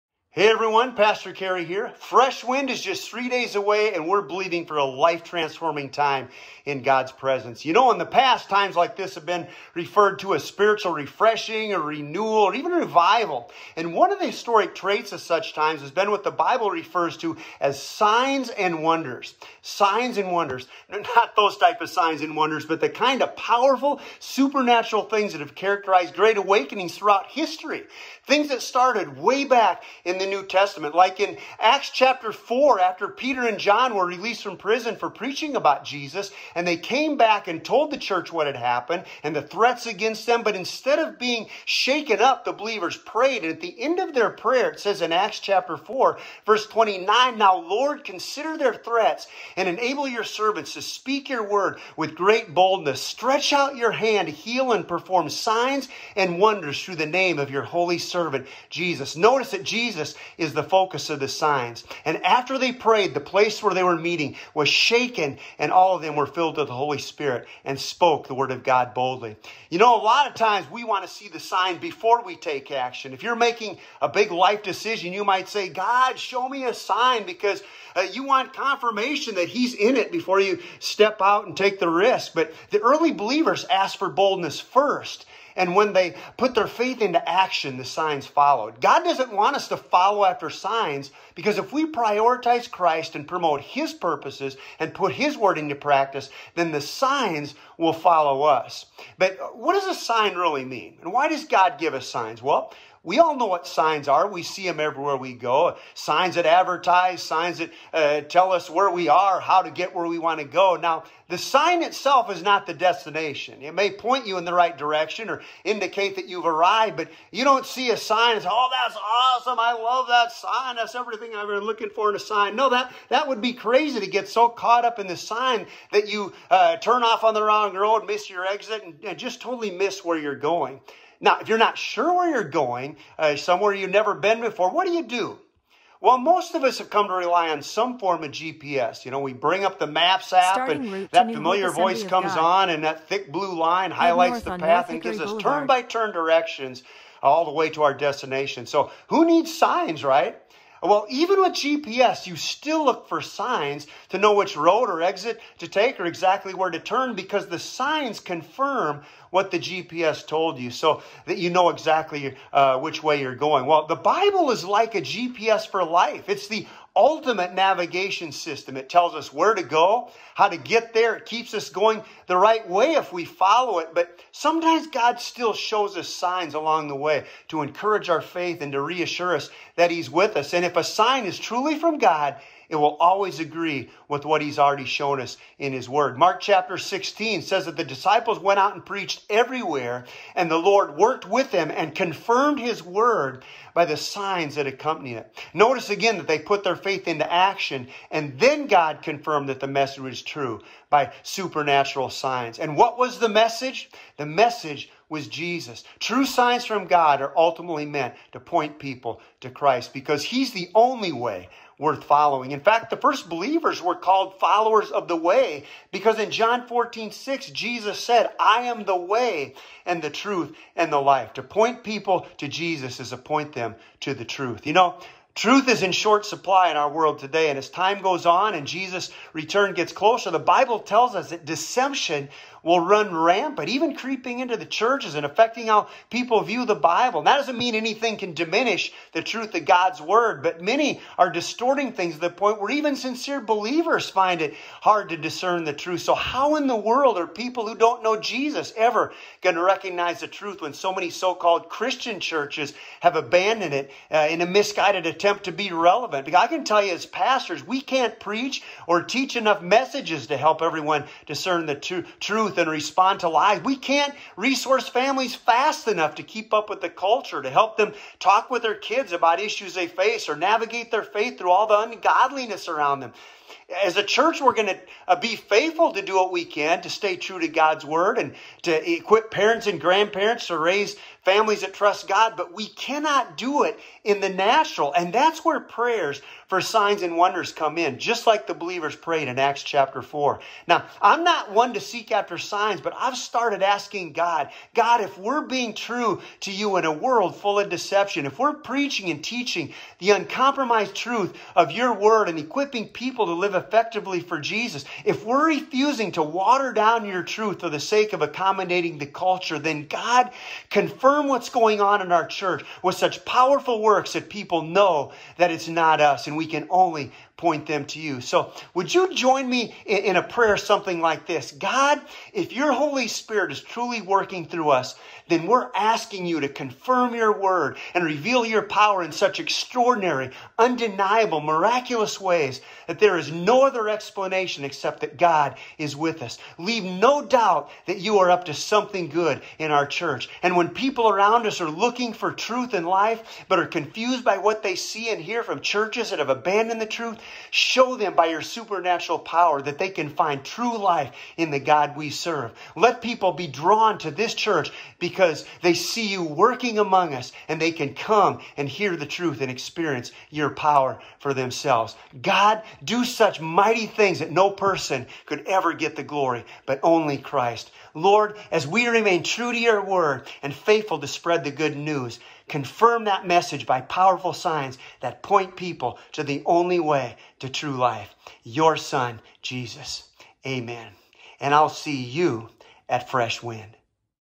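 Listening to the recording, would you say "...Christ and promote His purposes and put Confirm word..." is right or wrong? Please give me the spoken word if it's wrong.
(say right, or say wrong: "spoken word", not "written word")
wrong: "His", not "Confirm".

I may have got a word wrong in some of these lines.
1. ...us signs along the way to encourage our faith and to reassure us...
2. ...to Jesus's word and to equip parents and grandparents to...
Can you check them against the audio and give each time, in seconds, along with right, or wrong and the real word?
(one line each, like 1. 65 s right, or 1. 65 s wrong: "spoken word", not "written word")
1. 175 s right
2. 277 s wrong: "God", not "Jesus".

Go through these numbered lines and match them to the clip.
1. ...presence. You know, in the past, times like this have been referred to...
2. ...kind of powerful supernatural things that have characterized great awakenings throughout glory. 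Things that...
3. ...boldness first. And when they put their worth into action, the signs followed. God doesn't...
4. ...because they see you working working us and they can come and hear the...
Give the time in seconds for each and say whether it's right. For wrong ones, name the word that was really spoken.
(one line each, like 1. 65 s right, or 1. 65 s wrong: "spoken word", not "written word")
1. 7 s right
2. 22 s wrong: "history", not "glory"
3. 84 s wrong: "faith", not "worth"
4. 354 s wrong: "among", not "working".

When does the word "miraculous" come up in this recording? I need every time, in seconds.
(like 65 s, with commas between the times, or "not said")
331 s.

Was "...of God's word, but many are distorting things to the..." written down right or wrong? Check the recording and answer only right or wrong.
right.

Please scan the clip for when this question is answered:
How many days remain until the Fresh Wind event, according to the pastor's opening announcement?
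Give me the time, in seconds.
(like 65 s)
3 s.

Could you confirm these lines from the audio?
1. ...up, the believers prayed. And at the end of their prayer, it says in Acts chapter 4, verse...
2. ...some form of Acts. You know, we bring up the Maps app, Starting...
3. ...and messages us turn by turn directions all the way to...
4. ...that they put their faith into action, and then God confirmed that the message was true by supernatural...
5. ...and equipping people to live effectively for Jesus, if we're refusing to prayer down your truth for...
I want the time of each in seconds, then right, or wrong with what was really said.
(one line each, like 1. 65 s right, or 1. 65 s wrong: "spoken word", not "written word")
1. 42 s right
2. 137 s wrong: "GPS", not "Acts"
3. 144 s wrong: "gives", not "messages"
4. 196 s right
5. 302 s wrong: "water", not "prayer".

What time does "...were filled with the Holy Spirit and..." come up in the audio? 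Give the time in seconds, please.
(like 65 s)
66 s.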